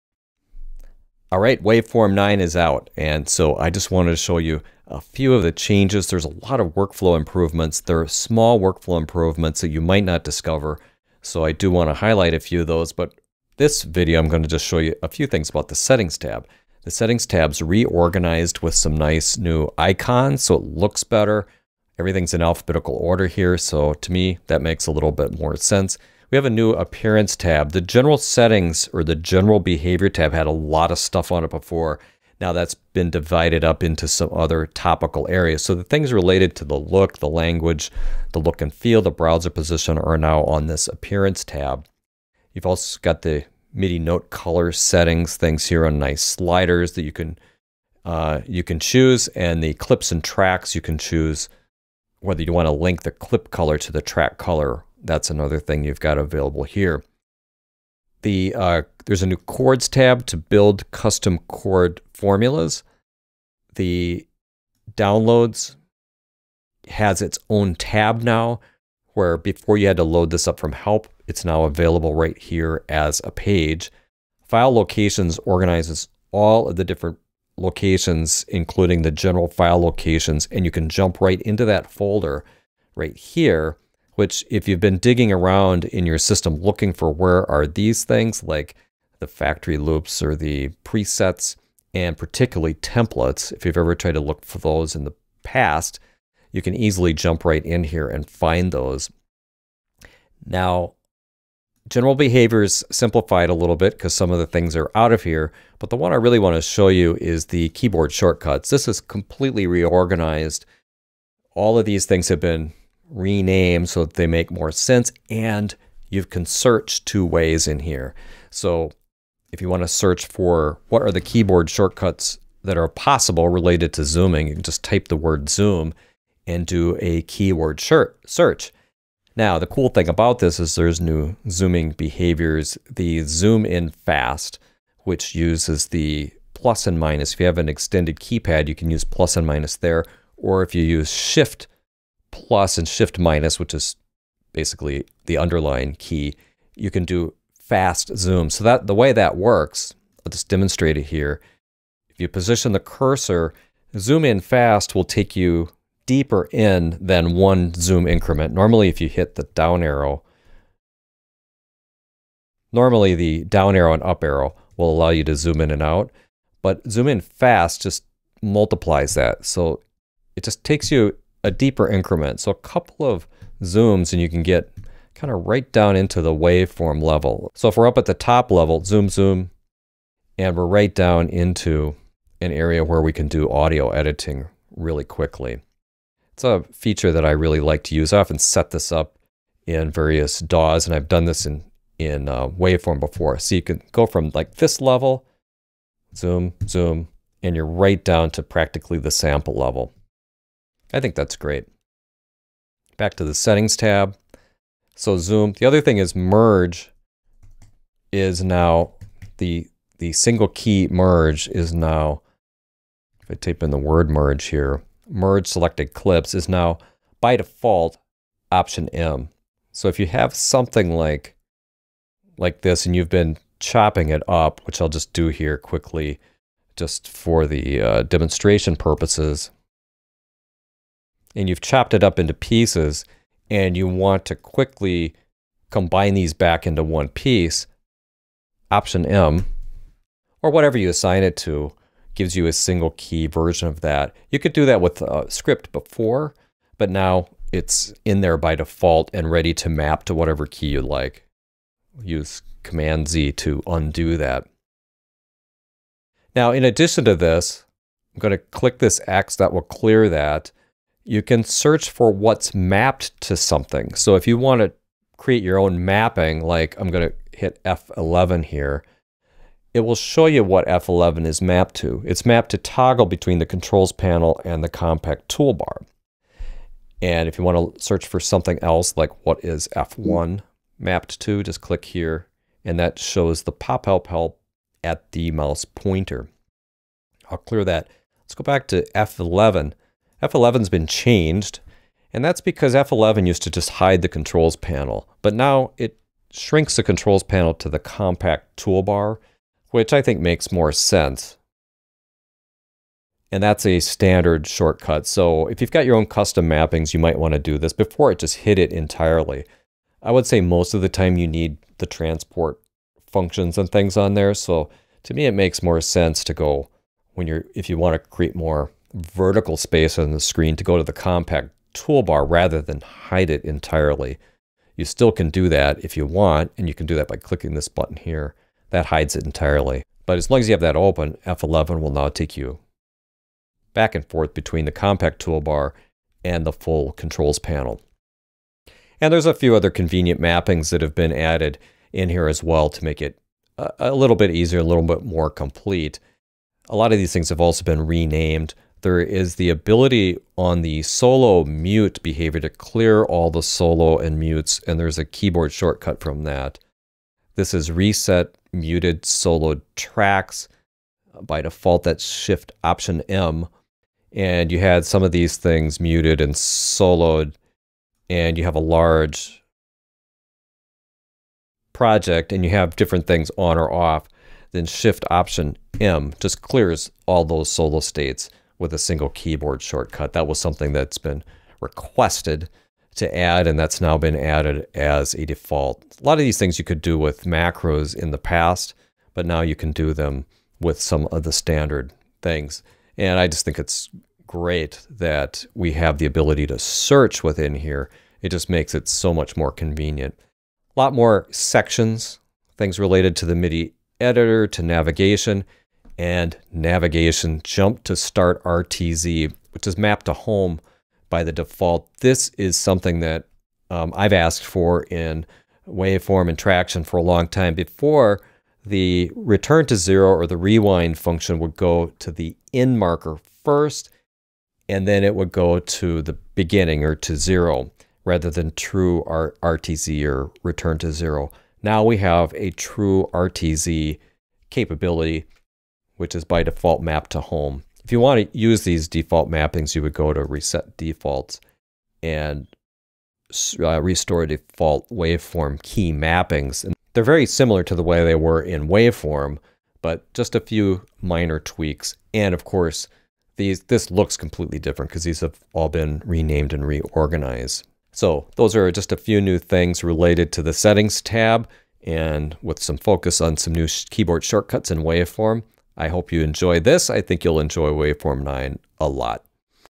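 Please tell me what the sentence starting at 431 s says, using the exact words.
Now we have a true RTZ capability which is by default mapped to home.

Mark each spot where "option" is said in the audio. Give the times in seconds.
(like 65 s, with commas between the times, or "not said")
218 s, 238 s, 362 s, 375 s.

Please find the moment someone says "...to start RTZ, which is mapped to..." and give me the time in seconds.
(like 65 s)
407 s.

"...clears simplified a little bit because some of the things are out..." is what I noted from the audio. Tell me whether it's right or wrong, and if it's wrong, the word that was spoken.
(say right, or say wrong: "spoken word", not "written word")
wrong: "behaviors", not "clears".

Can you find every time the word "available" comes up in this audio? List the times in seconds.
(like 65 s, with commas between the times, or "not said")
56 s, 71 s.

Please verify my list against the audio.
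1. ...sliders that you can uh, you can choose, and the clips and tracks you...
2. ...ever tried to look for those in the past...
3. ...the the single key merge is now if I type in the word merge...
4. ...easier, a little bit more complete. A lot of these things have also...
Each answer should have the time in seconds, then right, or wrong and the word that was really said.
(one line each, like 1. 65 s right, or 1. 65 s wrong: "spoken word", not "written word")
1. 46 s right
2. 93 s right
3. 209 s right
4. 344 s right.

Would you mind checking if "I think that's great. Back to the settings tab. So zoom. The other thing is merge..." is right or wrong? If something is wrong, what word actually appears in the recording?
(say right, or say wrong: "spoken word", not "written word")
right.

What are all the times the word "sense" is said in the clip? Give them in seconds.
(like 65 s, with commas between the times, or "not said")
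25 s, 114 s, 300 s, 315 s.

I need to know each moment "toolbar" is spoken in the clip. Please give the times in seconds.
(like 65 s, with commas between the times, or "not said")
275 s, 298 s, 321 s, 335 s.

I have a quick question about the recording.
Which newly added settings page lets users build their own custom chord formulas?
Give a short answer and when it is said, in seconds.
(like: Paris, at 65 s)
Chords tab, at 59 s.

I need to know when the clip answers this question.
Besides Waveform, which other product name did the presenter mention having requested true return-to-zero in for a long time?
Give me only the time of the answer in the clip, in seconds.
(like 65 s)
416 s.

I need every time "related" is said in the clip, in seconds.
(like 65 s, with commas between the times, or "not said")
36 s, 123 s, 402 s, 459 s.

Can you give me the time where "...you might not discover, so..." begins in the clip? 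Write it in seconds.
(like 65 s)
9 s.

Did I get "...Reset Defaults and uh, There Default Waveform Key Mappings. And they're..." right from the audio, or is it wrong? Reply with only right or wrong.
wrong.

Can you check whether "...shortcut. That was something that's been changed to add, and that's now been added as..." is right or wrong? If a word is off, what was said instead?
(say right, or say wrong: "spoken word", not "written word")
wrong: "requested", not "changed".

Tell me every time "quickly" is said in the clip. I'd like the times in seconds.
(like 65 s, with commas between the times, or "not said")
185 s, 225 s, 234 s.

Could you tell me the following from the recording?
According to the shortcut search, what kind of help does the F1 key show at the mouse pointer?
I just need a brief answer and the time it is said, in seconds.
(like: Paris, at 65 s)
Pop help, at 283 s.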